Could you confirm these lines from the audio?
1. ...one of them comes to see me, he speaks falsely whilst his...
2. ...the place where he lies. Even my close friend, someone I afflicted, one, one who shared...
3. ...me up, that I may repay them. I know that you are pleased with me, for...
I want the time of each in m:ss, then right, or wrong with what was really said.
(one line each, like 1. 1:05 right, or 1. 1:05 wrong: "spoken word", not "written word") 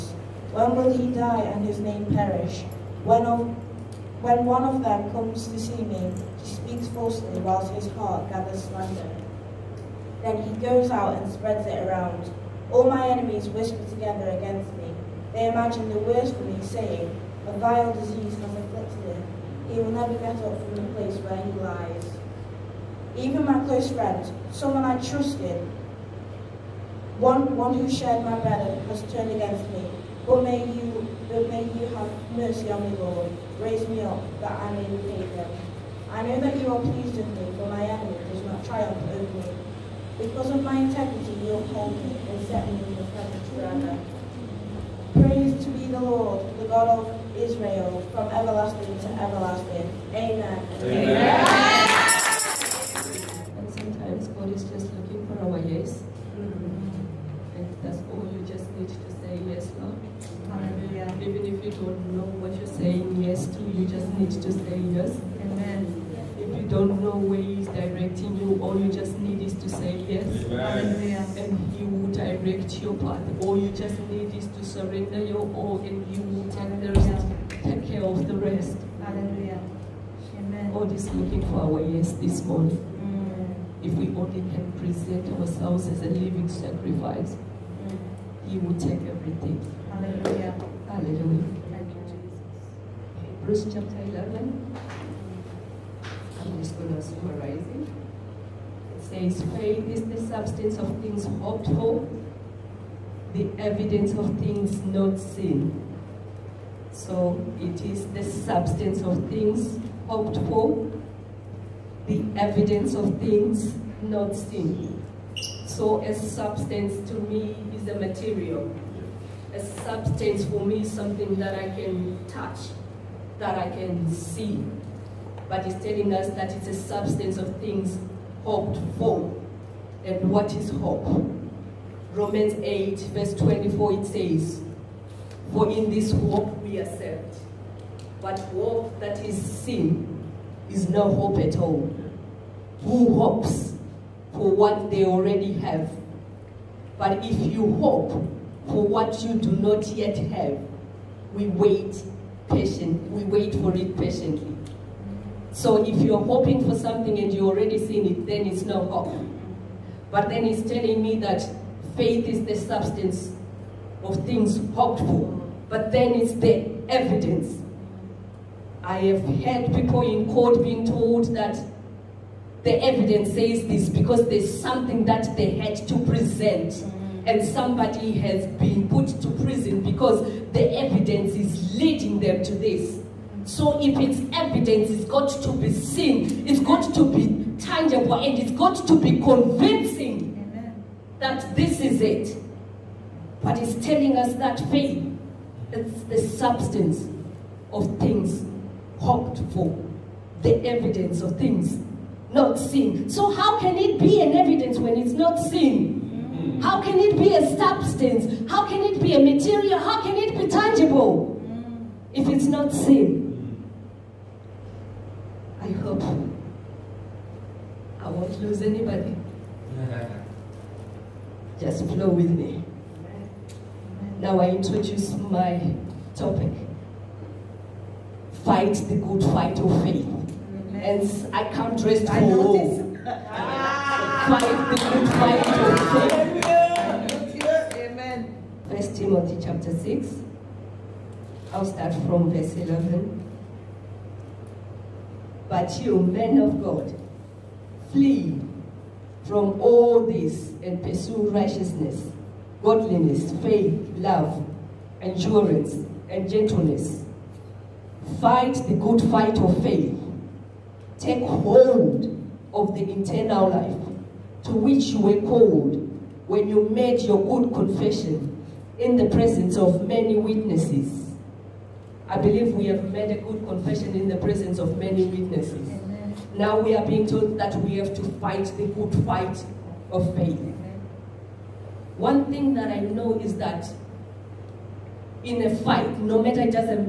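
1. 0:04 right
2. 0:20 wrong: "trusted", not "afflicted"
3. 0:33 right.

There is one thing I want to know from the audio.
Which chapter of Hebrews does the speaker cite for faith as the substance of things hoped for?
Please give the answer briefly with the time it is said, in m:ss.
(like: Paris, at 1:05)
Hebrews chapter 11, at 1:33.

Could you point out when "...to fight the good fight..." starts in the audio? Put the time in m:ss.
4:37.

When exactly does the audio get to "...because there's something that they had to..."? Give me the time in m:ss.
2:53.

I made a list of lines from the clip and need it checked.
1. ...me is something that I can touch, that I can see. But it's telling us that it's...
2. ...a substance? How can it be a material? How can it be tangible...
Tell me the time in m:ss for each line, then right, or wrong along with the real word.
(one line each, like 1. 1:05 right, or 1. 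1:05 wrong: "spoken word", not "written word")
1. 2:00 right
2. 3:27 right.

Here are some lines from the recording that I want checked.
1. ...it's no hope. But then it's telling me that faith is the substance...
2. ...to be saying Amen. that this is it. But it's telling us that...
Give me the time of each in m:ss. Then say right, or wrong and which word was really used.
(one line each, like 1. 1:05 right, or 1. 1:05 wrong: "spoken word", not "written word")
1. 2:38 right
2. 3:08 wrong: "convincing", not "saying".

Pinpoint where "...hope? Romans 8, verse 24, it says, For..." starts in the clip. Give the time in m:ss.
2:10.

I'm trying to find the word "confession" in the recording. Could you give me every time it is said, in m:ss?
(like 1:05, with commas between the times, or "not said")
4:27, 4:33.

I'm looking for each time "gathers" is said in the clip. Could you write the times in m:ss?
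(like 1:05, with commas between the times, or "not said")
0:08.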